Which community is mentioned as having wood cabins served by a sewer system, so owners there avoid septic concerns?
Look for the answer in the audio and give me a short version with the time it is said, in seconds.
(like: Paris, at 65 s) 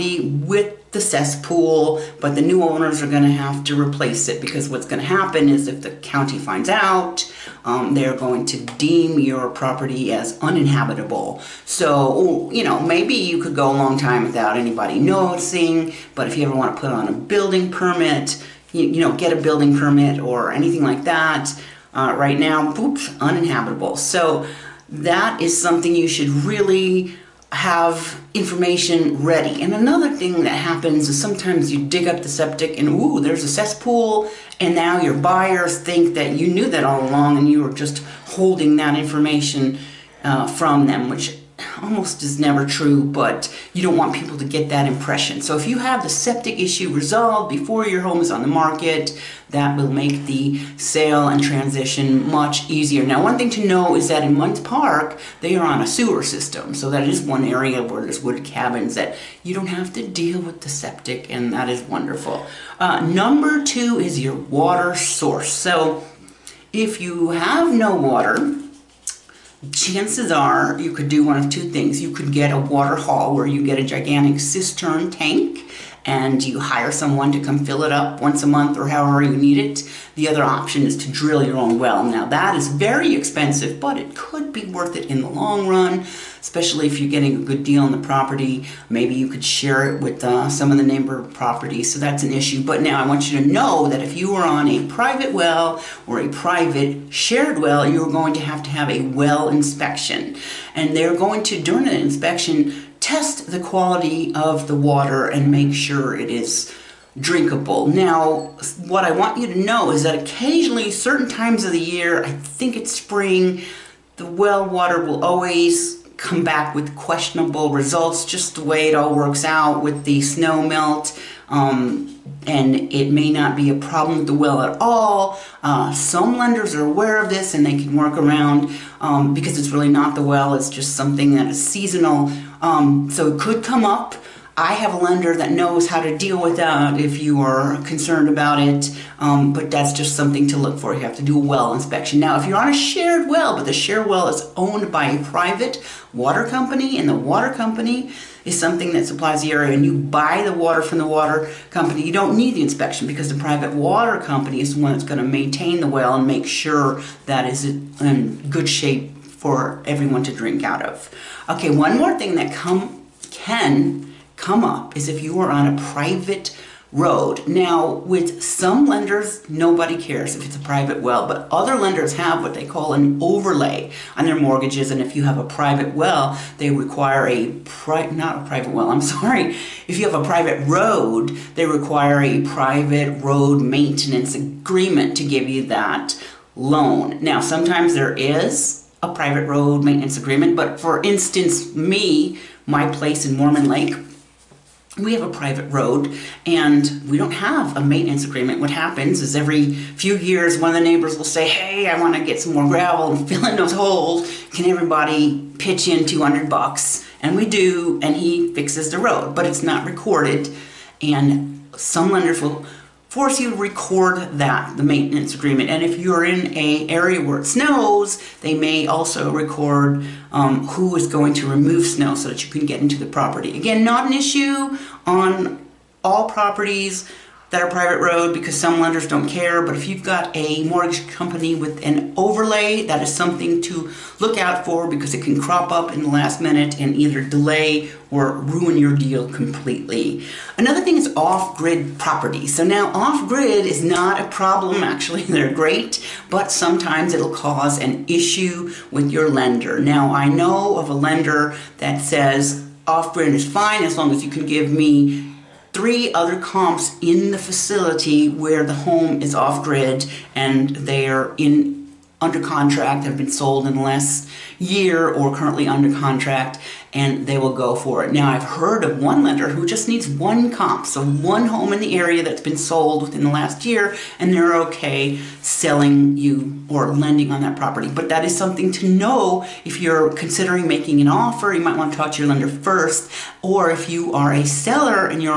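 Munds Park, at 54 s.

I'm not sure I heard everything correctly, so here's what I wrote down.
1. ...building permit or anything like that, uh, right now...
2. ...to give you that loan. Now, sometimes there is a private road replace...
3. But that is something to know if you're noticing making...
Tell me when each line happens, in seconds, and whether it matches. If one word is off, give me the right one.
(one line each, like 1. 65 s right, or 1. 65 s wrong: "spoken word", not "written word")
1. 19 s right
2. 185 s wrong: "maintenance", not "replace"
3. 277 s wrong: "considering", not "noticing".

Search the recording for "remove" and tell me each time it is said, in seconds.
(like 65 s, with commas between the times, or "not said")
221 s.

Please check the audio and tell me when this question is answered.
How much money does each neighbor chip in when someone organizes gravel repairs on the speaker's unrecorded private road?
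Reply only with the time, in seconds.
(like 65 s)
206 s.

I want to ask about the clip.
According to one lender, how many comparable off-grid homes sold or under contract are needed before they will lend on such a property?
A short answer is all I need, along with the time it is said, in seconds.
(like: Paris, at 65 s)
3, at 255 s.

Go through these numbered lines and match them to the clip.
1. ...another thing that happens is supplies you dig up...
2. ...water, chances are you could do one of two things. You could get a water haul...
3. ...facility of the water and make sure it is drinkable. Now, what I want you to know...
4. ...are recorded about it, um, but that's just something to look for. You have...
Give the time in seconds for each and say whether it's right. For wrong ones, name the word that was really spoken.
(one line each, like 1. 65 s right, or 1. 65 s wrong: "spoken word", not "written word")
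1. 29 s wrong: "sometimes", not "supplies"
2. 67 s right
3. 103 s wrong: "quality", not "facility"
4. 137 s wrong: "concerned", not "recorded".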